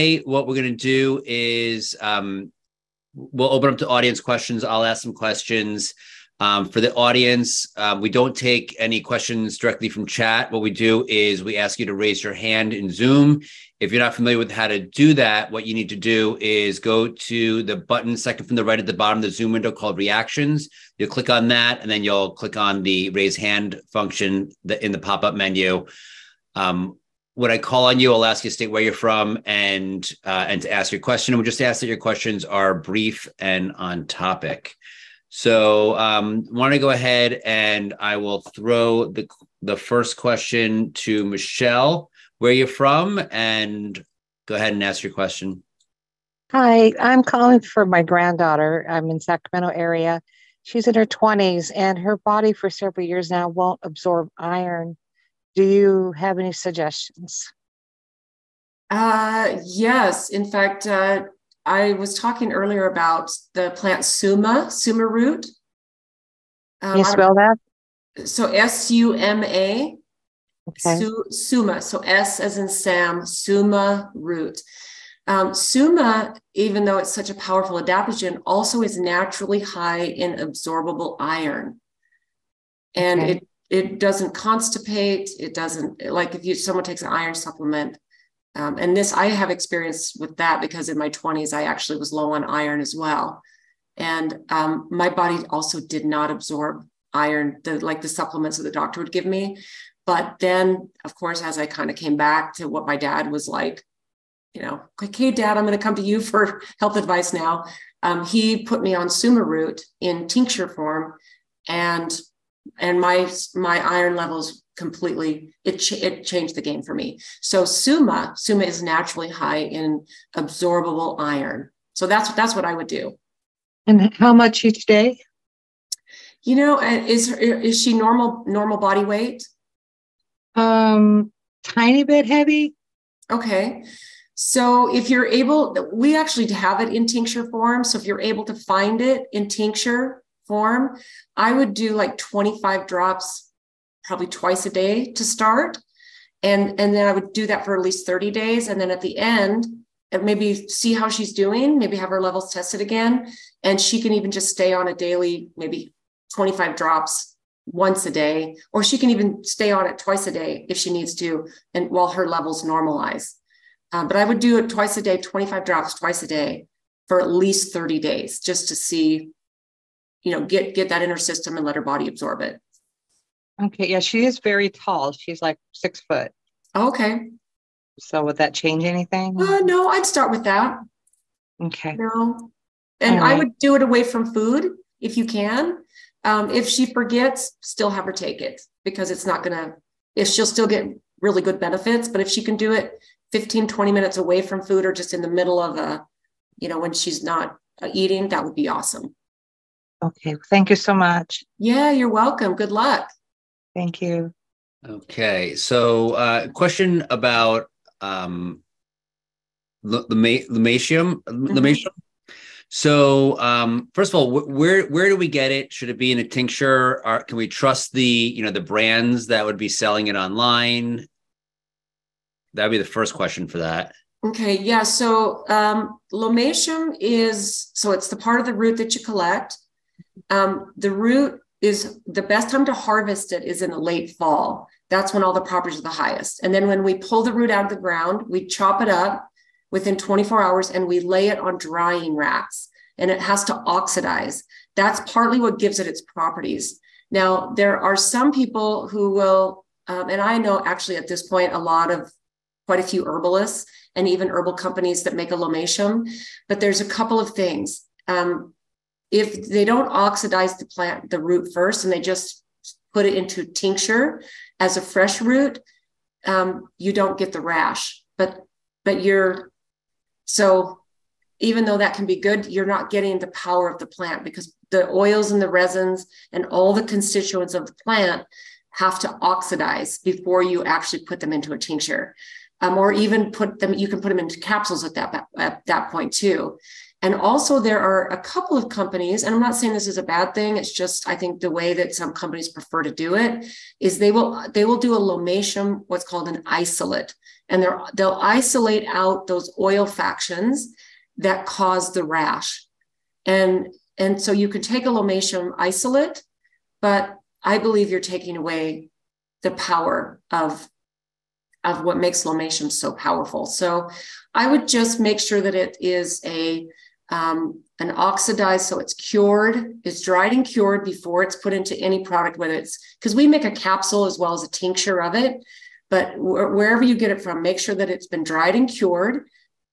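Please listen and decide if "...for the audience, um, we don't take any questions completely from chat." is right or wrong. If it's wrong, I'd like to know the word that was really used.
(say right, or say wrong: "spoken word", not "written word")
wrong: "directly", not "completely".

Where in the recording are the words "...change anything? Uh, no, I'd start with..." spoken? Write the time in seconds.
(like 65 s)
178 s.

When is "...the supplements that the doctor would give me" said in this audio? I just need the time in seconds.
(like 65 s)
98 s.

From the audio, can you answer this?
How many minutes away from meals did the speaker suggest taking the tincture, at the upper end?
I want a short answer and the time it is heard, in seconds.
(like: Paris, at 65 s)
20, at 193 s.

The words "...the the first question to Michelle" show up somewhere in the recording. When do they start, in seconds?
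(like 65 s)
39 s.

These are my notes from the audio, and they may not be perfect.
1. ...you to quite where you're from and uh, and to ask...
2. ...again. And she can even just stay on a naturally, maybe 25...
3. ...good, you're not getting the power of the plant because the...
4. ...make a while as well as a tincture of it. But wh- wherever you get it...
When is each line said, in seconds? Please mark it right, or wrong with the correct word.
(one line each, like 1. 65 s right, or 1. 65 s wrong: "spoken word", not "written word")
1. 28 s wrong: "state", not "quite"
2. 152 s wrong: "daily", not "naturally"
3. 272 s right
4. 323 s wrong: "capsule", not "while".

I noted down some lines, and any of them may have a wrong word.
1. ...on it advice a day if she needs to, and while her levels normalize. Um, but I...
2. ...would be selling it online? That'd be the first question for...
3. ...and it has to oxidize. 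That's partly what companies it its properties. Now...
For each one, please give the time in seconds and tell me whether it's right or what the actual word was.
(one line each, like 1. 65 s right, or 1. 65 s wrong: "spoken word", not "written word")
1. 159 s wrong: "twice", not "advice"
2. 219 s right
3. 242 s wrong: "gives", not "companies".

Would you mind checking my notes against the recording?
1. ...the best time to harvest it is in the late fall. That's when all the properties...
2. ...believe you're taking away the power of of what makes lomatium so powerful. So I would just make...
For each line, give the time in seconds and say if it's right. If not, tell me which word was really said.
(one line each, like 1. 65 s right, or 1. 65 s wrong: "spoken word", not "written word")
1. 232 s right
2. 307 s right.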